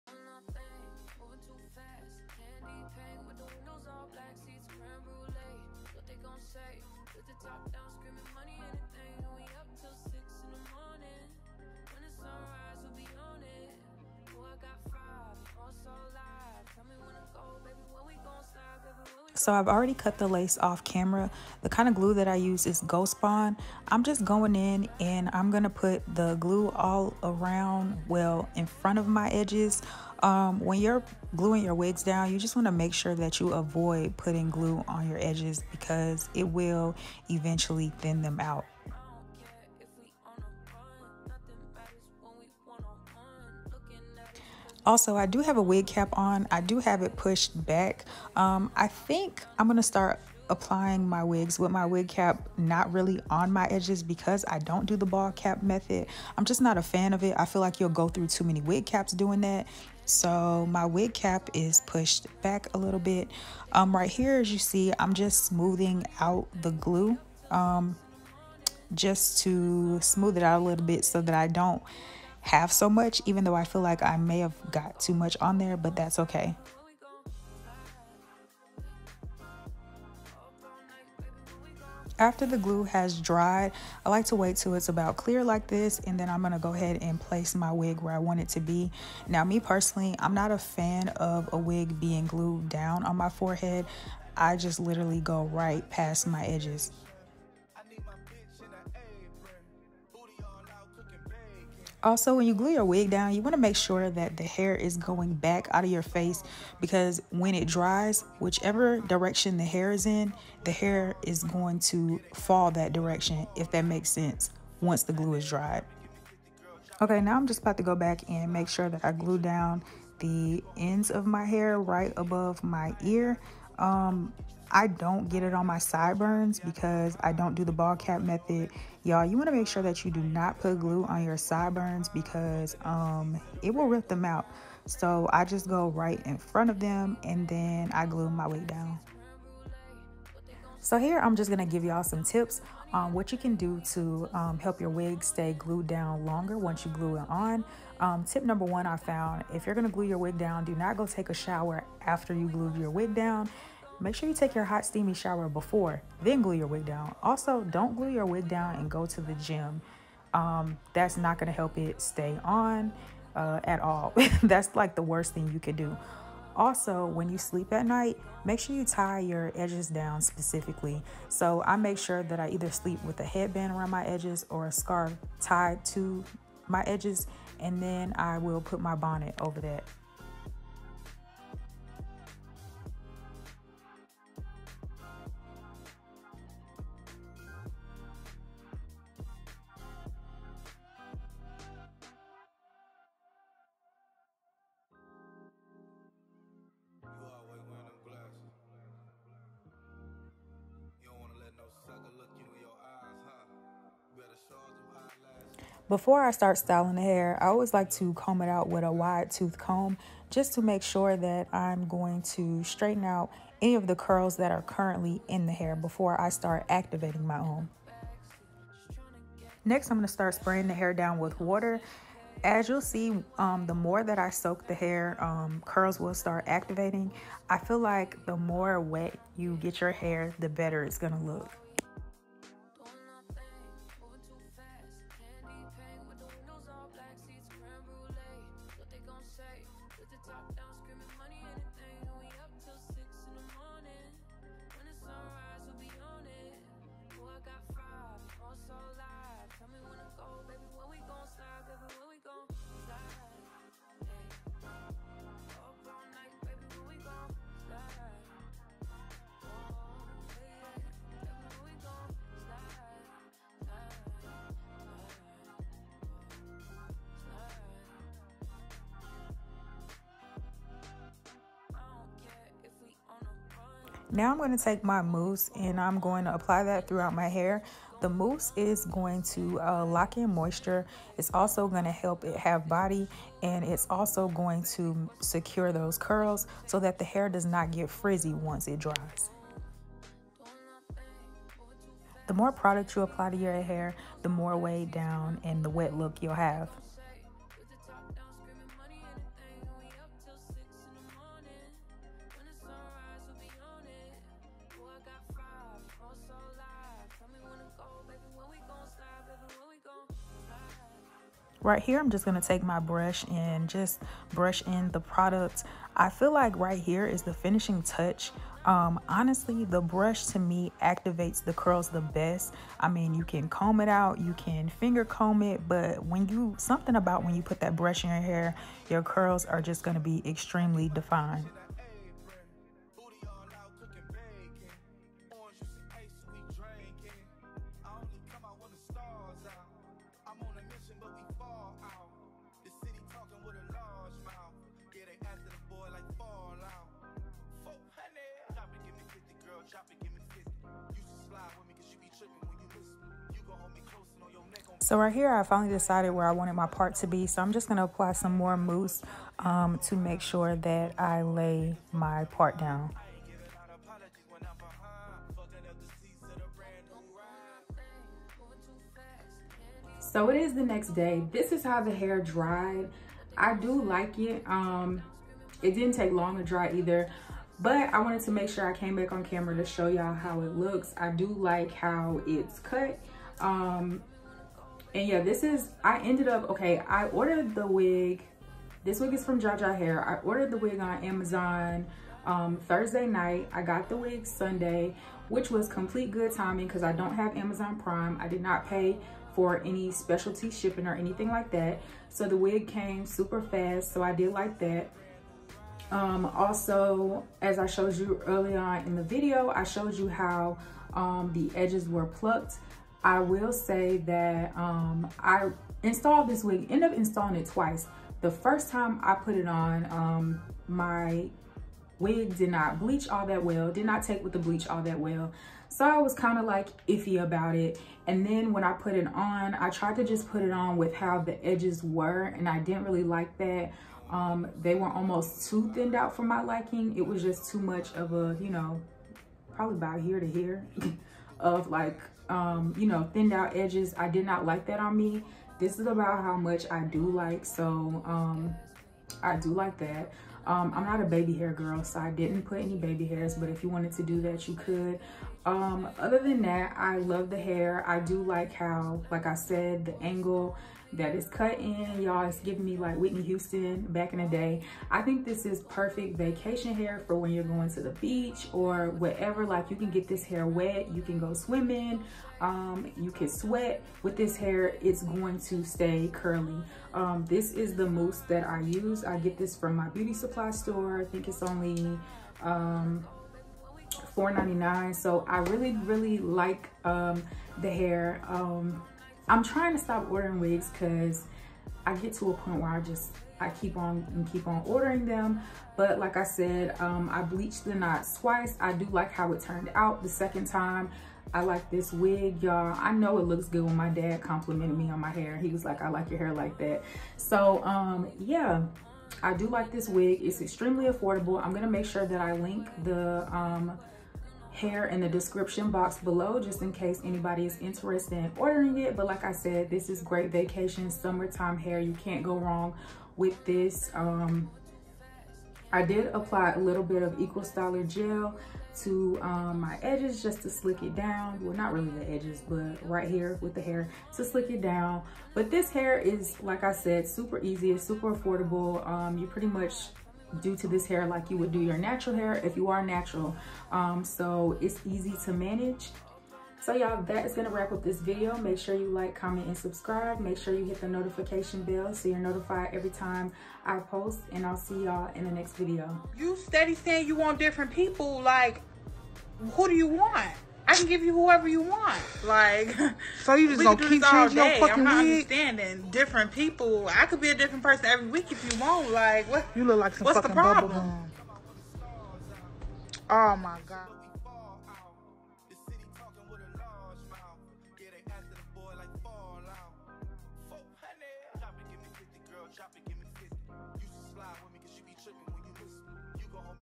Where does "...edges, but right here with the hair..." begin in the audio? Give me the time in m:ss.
8:52.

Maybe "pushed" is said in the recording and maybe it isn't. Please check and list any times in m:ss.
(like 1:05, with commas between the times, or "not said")
0:47, 1:01.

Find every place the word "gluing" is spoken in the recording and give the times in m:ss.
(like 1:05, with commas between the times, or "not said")
0:31.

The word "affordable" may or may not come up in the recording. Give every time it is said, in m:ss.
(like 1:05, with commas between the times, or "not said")
8:30, 8:58.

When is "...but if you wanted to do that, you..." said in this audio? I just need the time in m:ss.
7:33.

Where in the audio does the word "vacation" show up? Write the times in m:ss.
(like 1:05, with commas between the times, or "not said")
7:46, 8:40.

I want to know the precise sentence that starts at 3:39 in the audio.
Next, I'm gonna start spraying the hair down with water.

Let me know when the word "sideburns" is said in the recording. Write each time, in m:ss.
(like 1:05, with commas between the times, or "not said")
2:05, 2:11.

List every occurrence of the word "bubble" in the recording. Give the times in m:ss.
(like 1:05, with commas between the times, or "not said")
9:30.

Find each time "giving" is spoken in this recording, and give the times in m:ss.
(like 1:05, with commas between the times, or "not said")
7:42.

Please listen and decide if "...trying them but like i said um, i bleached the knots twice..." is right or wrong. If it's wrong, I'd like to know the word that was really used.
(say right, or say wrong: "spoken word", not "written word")
wrong: "ordering", not "trying".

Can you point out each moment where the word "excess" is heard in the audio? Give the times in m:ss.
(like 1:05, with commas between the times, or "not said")
not said.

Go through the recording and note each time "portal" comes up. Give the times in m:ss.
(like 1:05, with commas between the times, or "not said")
not said.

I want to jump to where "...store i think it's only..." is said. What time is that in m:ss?
8:00.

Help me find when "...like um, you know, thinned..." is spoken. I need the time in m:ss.
7:21.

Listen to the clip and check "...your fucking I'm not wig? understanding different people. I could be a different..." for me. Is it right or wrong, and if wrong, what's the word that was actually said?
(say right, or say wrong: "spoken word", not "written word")
right.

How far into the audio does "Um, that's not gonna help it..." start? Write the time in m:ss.
2:40.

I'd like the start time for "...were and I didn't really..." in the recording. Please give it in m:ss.
7:11.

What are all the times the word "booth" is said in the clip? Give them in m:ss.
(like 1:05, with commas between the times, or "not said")
not said.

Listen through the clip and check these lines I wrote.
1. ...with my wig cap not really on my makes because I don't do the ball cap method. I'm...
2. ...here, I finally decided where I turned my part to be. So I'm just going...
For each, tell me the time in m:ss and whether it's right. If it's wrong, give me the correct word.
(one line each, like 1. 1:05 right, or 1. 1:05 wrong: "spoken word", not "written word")
1. 0:51 wrong: "edges", not "makes"
2. 5:55 wrong: "wanted", not "turned".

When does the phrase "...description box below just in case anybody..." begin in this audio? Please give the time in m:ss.
8:35.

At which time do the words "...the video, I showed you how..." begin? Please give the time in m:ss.
6:48.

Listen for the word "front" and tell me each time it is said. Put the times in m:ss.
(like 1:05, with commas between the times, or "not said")
0:28, 2:16.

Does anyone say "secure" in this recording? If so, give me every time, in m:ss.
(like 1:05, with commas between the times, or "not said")
4:45.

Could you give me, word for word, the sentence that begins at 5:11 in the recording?
Right here, I'm just going to take my brush and just brush in the product.